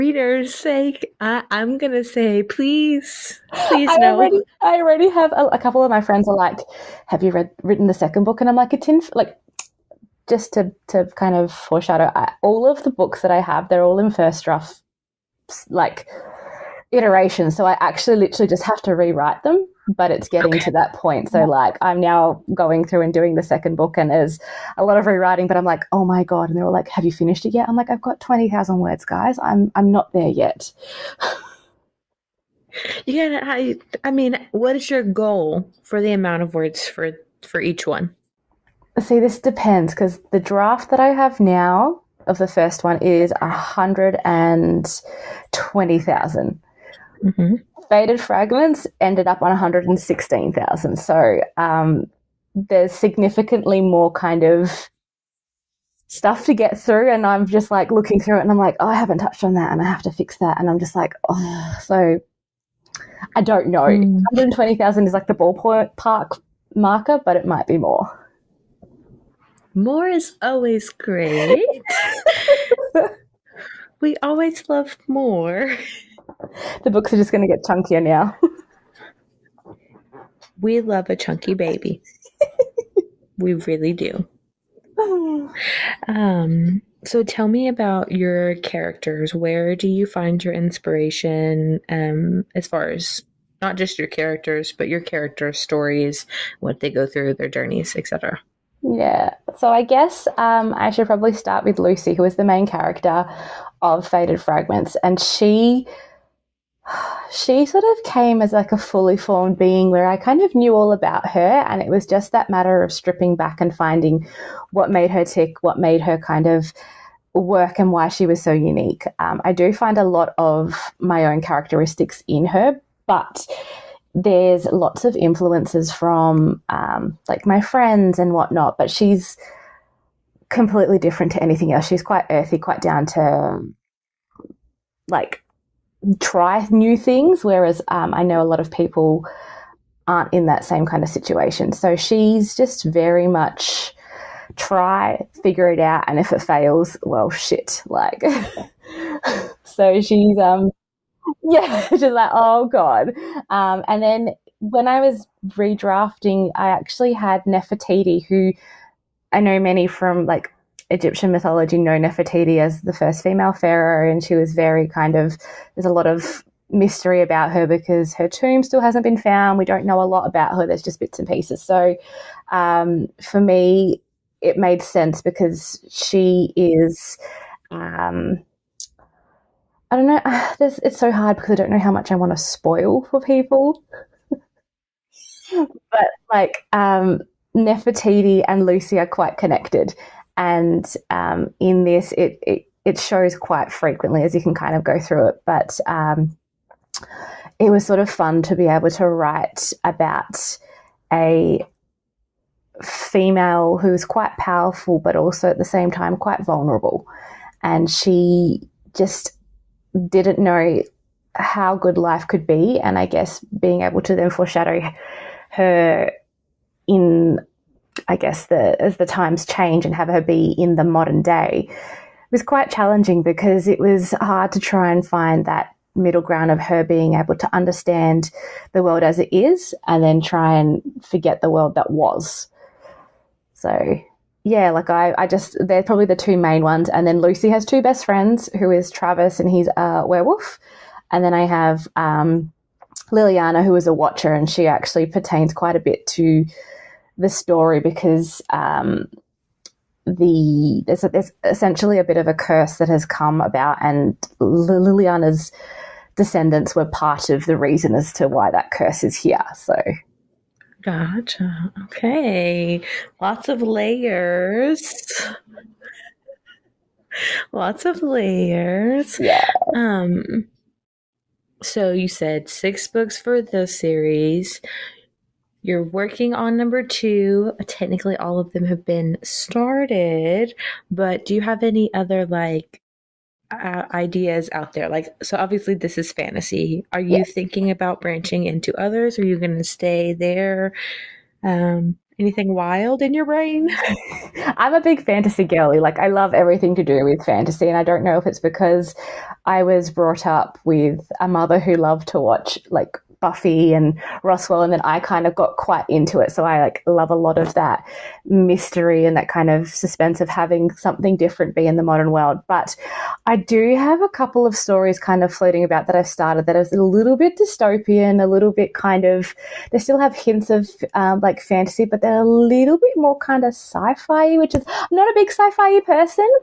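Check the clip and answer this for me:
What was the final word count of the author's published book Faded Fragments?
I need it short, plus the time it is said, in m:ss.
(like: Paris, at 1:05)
116,000, at 0:49.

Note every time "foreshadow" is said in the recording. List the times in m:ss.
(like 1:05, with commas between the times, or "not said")
0:11, 3:34.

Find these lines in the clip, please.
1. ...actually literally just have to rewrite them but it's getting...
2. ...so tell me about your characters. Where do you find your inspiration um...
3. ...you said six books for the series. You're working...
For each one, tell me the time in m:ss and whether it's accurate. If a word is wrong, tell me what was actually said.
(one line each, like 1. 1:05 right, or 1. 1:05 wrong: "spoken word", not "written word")
1. 0:17 right
2. 1:27 right
3. 4:31 right.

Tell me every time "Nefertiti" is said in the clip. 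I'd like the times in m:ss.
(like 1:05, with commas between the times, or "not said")
2:37, 2:41, 3:07.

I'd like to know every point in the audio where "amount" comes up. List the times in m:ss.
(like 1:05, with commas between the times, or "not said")
0:36.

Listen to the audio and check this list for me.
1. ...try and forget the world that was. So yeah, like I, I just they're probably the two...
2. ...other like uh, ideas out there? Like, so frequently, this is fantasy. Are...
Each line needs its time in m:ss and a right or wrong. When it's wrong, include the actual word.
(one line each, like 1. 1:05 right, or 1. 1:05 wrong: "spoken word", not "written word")
1. 3:50 right
2. 4:41 wrong: "obviously", not "frequently".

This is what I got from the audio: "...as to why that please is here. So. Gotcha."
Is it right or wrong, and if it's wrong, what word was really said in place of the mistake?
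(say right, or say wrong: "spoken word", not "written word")
wrong: "curse", not "please".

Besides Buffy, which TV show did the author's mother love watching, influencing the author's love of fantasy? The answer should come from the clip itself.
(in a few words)
Roswell.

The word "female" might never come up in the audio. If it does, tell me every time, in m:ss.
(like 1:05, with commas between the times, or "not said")
2:43, 3:22.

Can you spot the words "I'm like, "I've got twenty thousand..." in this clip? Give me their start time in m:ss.
0:27.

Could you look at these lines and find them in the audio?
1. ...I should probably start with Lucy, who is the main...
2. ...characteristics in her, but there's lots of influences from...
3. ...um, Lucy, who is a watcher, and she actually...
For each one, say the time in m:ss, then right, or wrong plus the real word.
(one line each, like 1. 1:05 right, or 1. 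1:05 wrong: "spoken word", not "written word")
1. 1:40 right
2. 2:01 right
3. 4:01 wrong: "Liliana", not "Lucy".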